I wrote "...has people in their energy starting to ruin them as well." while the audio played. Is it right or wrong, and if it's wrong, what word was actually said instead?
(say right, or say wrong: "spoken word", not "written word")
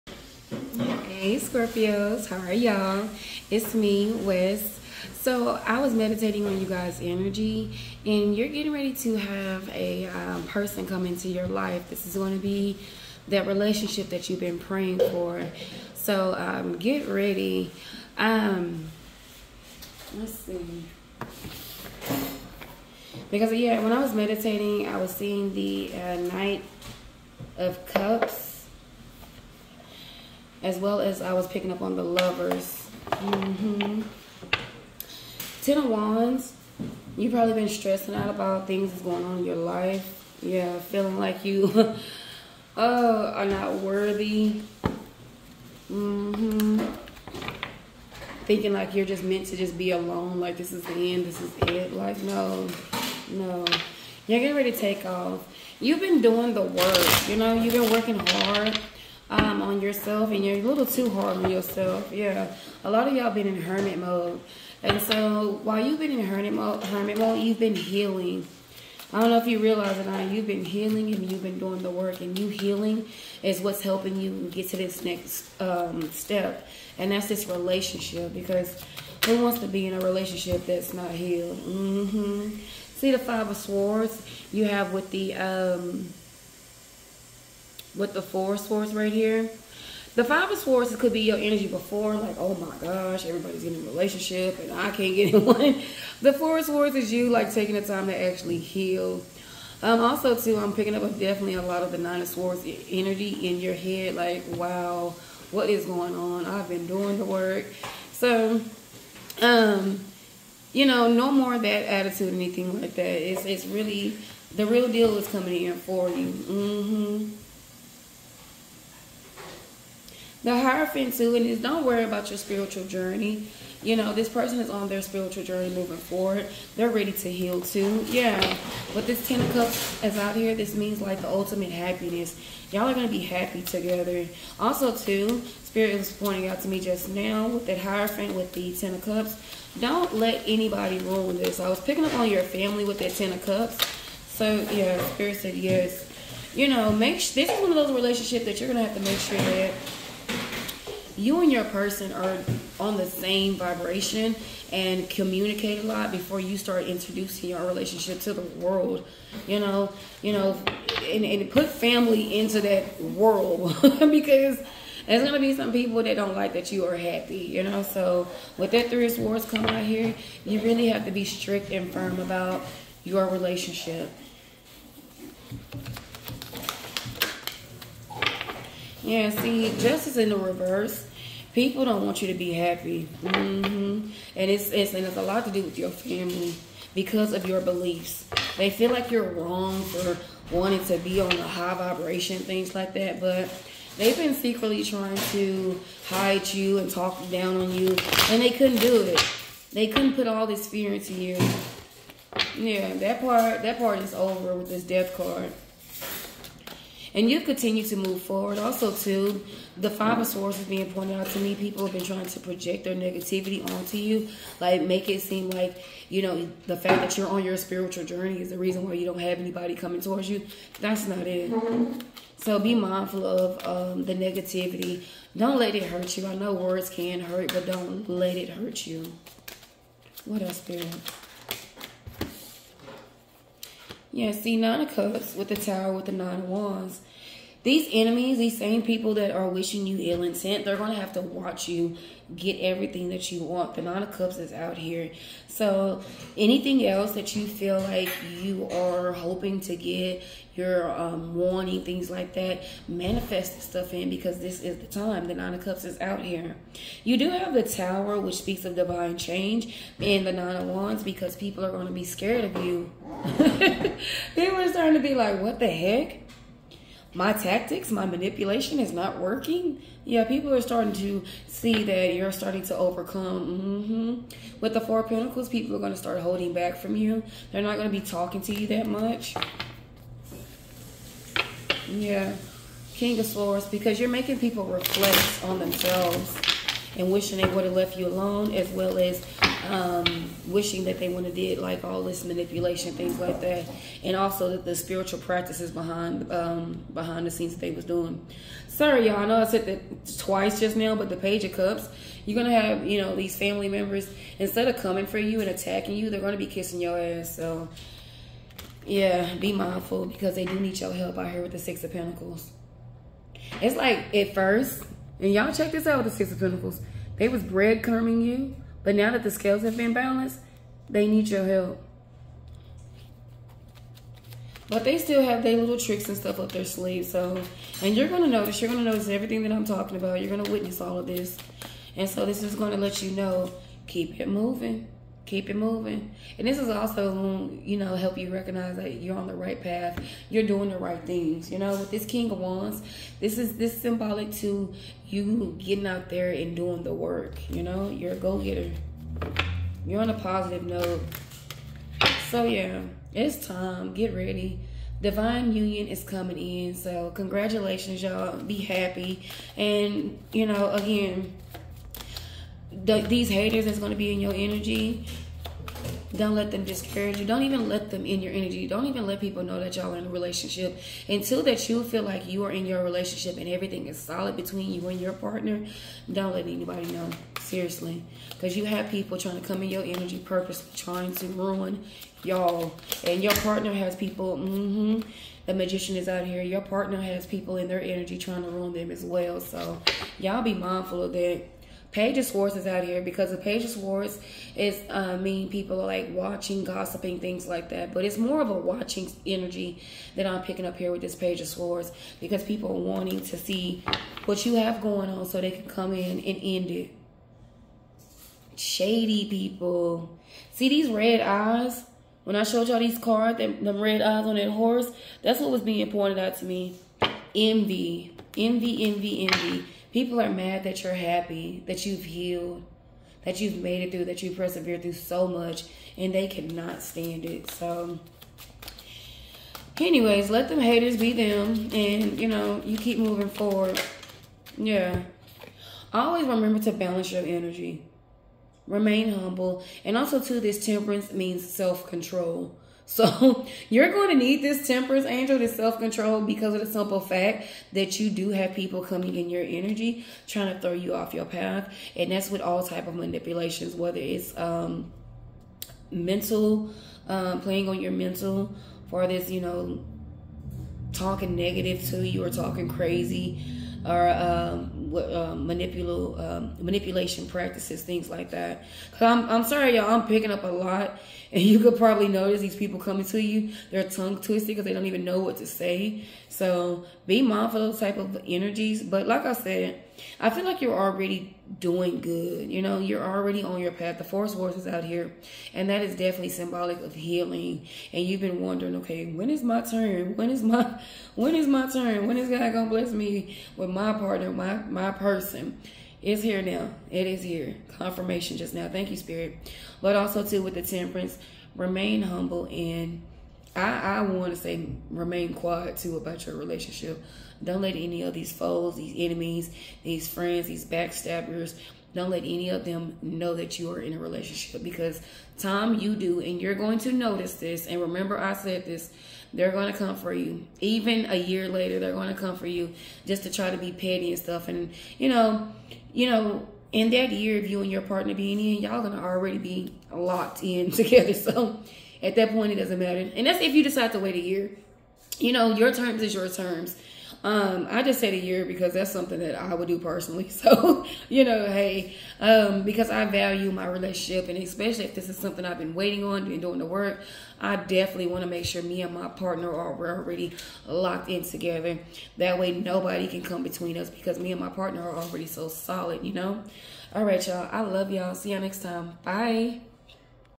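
wrong: "trying", not "starting".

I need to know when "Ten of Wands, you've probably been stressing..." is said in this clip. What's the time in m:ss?
0:35.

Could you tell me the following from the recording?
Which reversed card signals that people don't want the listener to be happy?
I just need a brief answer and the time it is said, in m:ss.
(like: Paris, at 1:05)
Justice, at 2:59.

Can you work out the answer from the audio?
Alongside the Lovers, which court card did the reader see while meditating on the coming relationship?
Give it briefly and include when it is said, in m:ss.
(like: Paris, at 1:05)
Knight of Cups, at 0:26.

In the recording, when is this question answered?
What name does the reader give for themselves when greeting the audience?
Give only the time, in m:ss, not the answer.
0:04.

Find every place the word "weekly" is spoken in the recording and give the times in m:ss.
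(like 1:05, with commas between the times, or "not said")
not said.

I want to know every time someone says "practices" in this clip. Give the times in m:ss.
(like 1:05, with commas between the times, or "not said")
4:55, 7:47.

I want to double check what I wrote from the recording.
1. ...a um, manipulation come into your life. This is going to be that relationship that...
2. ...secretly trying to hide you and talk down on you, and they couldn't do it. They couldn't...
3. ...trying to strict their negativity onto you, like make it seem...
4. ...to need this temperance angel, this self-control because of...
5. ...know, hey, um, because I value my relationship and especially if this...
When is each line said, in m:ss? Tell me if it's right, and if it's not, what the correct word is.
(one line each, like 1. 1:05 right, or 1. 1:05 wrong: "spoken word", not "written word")
1. 0:09 wrong: "person", not "manipulation"
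2. 3:14 right
3. 3:32 wrong: "project", not "strict"
4. 7:24 right
5. 9:01 right.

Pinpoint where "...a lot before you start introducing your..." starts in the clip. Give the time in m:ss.
2:35.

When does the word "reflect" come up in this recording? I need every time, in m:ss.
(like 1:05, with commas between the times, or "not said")
4:44.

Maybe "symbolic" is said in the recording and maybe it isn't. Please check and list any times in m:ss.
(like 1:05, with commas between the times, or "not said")
5:43, 8:06.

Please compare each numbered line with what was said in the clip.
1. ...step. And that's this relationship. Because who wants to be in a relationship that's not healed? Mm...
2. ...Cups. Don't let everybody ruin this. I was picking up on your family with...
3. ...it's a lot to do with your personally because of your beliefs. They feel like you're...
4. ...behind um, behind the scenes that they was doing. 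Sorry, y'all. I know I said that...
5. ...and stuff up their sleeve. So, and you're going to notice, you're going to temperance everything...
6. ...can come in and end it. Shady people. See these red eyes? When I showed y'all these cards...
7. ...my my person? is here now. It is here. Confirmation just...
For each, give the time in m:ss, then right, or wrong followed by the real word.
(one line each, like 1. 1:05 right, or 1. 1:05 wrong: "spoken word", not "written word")
1. 1:16 right
2. 2:19 wrong: "anybody", not "everybody"
3. 3:05 wrong: "family", not "personally"
4. 4:55 right
5. 5:26 wrong: "notice", not "temperance"
6. 6:45 right
7. 8:14 right.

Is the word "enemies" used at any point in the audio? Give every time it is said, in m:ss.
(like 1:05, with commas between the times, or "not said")
3:57, 8:28.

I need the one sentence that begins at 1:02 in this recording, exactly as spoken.
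Yeah, a lot of y'all been in hermit mode.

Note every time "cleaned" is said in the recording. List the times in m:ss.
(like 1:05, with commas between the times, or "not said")
not said.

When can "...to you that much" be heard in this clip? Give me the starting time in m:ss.
4:38.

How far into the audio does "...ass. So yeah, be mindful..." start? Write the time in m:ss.
5:06.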